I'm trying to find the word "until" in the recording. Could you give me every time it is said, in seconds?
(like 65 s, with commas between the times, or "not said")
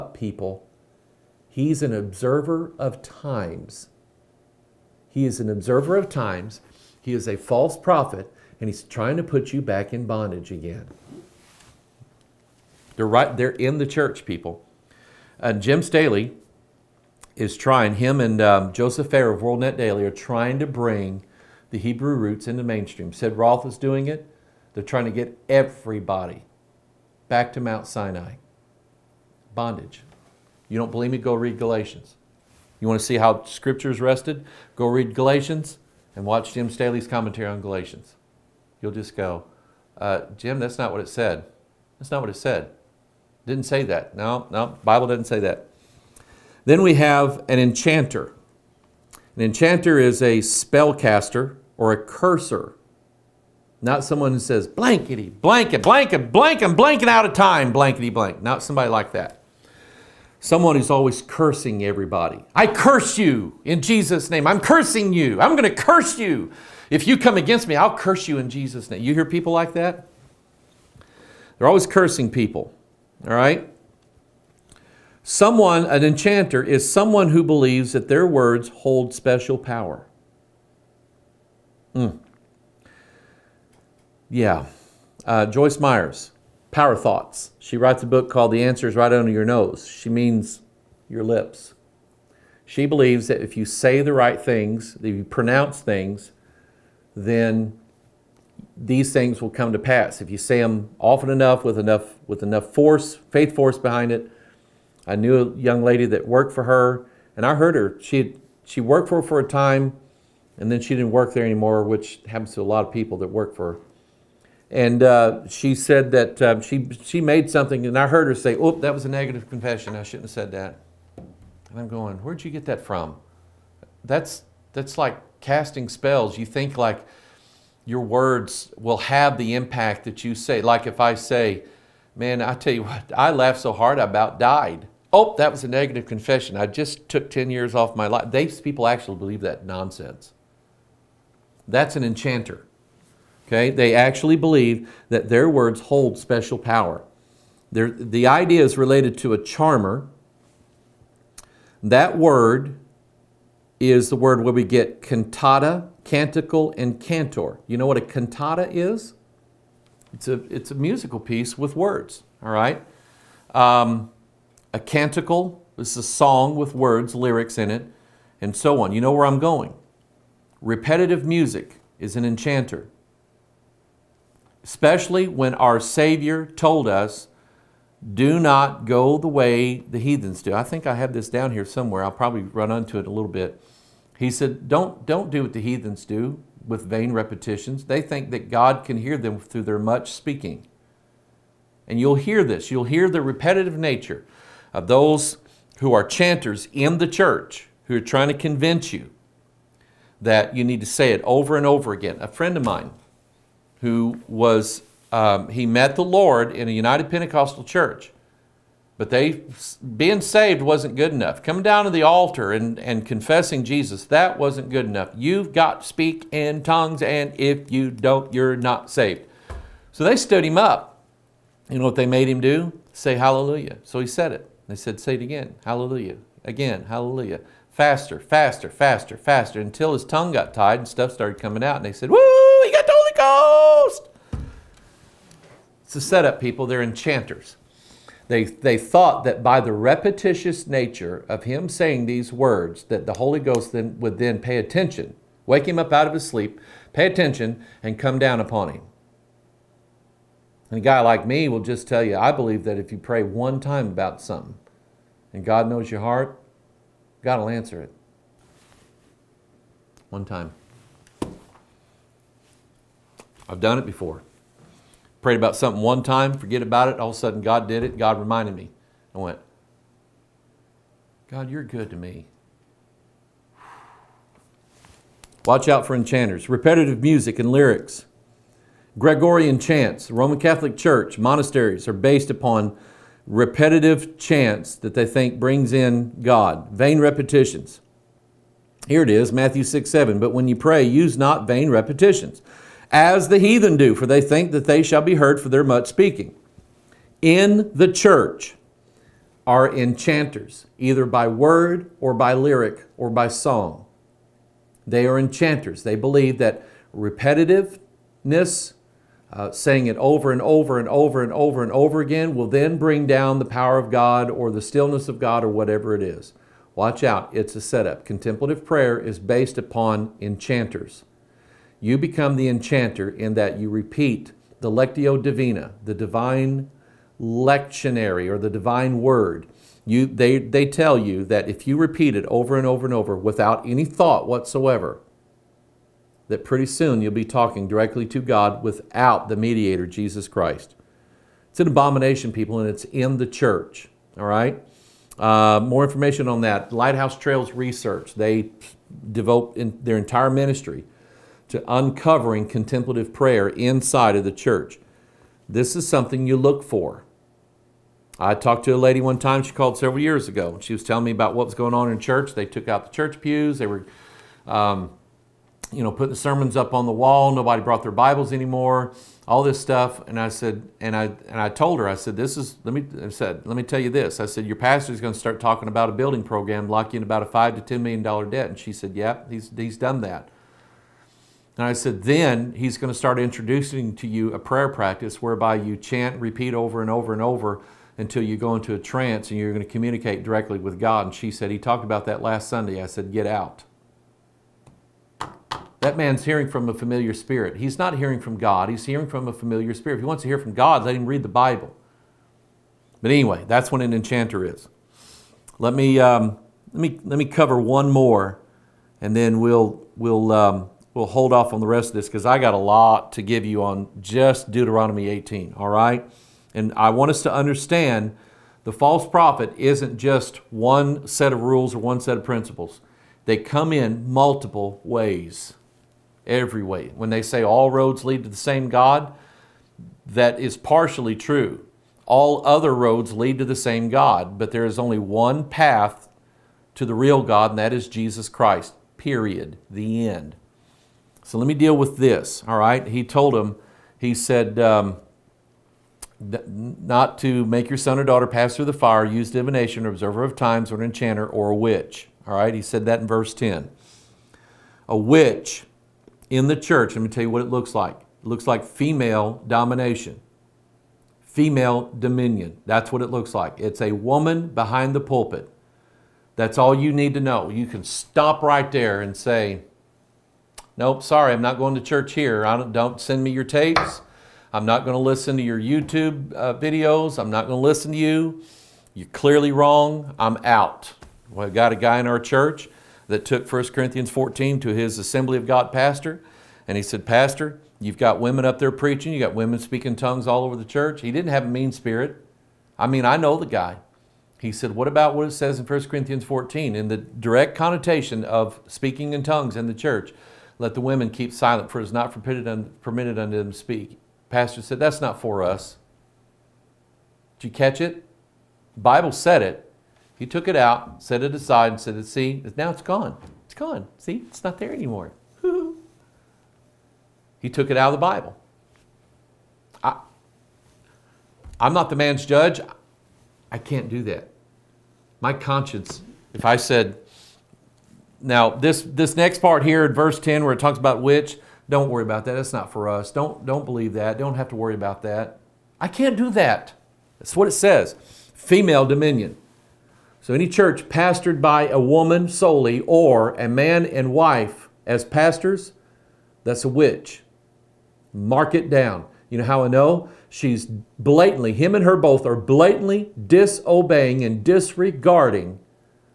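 229 s, 387 s.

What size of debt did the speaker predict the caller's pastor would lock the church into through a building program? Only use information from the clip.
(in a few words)
$5 to $10 million.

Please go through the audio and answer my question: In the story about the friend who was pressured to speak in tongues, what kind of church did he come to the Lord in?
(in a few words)
United Pentecostal church.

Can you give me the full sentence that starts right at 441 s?
So let me deal with this, all right?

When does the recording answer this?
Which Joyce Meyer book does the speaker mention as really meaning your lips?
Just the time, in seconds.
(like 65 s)
88 s.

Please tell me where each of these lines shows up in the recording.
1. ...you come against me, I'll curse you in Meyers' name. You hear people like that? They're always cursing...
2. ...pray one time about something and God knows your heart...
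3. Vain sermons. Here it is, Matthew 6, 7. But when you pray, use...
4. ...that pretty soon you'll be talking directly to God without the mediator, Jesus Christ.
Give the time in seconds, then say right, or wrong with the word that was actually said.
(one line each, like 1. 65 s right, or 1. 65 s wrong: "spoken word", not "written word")
1. 67 s wrong: "Jesus", not "Meyers"
2. 252 s right
3. 286 s wrong: "repetitions", not "sermons"
4. 336 s right.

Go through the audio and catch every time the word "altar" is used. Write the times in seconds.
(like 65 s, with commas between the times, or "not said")
212 s.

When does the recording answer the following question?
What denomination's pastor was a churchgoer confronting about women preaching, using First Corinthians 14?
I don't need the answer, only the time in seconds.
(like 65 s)
484 s.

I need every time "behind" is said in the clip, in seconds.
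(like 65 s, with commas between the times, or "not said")
103 s, 464 s.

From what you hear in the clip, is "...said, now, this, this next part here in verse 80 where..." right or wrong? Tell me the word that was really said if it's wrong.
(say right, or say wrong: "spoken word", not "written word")
wrong: "10", not "80".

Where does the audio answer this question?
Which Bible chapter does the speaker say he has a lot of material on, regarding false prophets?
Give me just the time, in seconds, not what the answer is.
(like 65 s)
414 s.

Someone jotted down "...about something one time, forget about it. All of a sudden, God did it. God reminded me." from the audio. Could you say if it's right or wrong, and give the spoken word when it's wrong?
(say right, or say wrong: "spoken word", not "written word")
right.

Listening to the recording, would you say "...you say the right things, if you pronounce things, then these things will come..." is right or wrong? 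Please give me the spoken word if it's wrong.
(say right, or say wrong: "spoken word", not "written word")
right.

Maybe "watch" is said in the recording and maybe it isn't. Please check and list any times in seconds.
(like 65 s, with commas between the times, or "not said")
36 s, 275 s, 316 s.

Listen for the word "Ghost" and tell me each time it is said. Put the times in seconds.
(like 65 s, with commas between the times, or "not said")
233 s, 243 s.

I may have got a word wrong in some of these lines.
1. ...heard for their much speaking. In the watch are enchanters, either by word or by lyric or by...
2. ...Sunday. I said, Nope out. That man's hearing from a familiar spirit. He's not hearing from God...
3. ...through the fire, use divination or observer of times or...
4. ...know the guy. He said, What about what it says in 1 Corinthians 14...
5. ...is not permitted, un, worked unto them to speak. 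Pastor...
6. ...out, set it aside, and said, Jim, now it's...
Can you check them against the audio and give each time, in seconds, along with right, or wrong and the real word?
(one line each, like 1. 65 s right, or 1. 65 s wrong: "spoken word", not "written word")
1. 295 s wrong: "church", not "watch"
2. 392 s wrong: "Get", not "Nope"
3. 448 s right
4. 493 s right
5. 501 s wrong: "permitted", not "worked"
6. 510 s wrong: "See", not "Jim".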